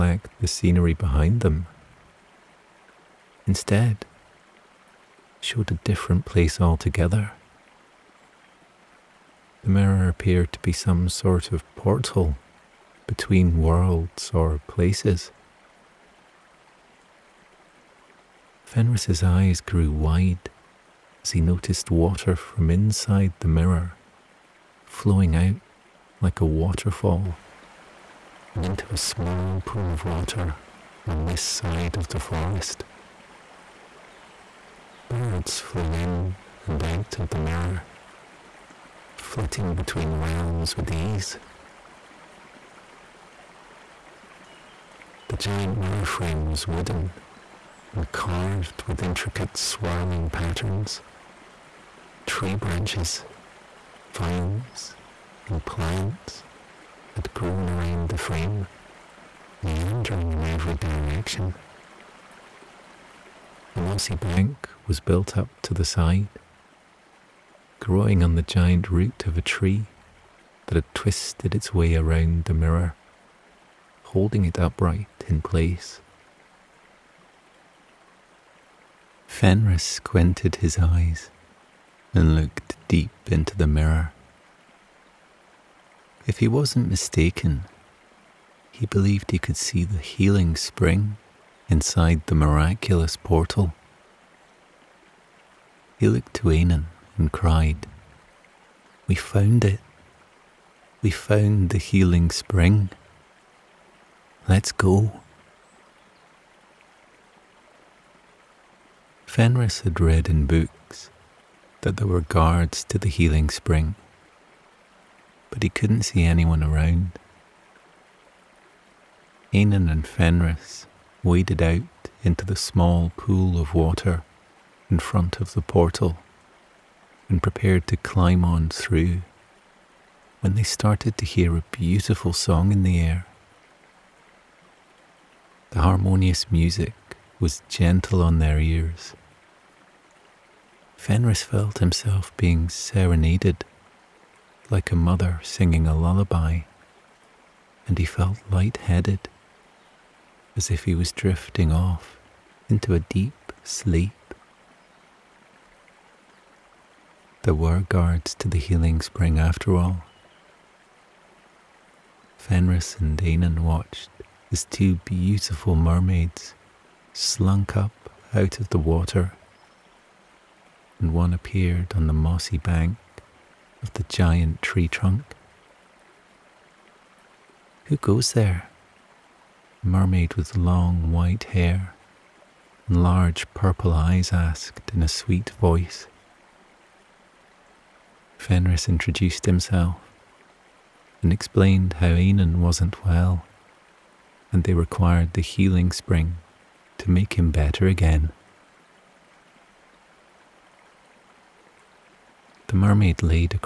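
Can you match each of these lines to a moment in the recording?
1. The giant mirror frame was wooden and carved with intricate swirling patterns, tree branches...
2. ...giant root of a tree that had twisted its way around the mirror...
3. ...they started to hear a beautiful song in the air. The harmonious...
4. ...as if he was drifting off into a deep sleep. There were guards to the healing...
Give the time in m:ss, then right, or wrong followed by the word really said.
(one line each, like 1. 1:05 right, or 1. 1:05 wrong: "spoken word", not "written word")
1. 0:45 right
2. 1:08 right
3. 2:10 right
4. 2:30 right.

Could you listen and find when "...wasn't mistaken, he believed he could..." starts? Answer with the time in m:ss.
1:26.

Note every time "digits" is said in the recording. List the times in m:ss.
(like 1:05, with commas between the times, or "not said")
not said.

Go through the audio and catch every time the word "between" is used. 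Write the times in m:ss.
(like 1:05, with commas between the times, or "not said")
0:13, 0:39.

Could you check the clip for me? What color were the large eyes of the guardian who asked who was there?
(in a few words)
Purple.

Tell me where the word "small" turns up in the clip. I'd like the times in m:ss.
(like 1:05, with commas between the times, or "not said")
0:28, 2:02.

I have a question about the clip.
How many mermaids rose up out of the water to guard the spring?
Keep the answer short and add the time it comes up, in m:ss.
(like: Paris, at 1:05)
2, at 2:44.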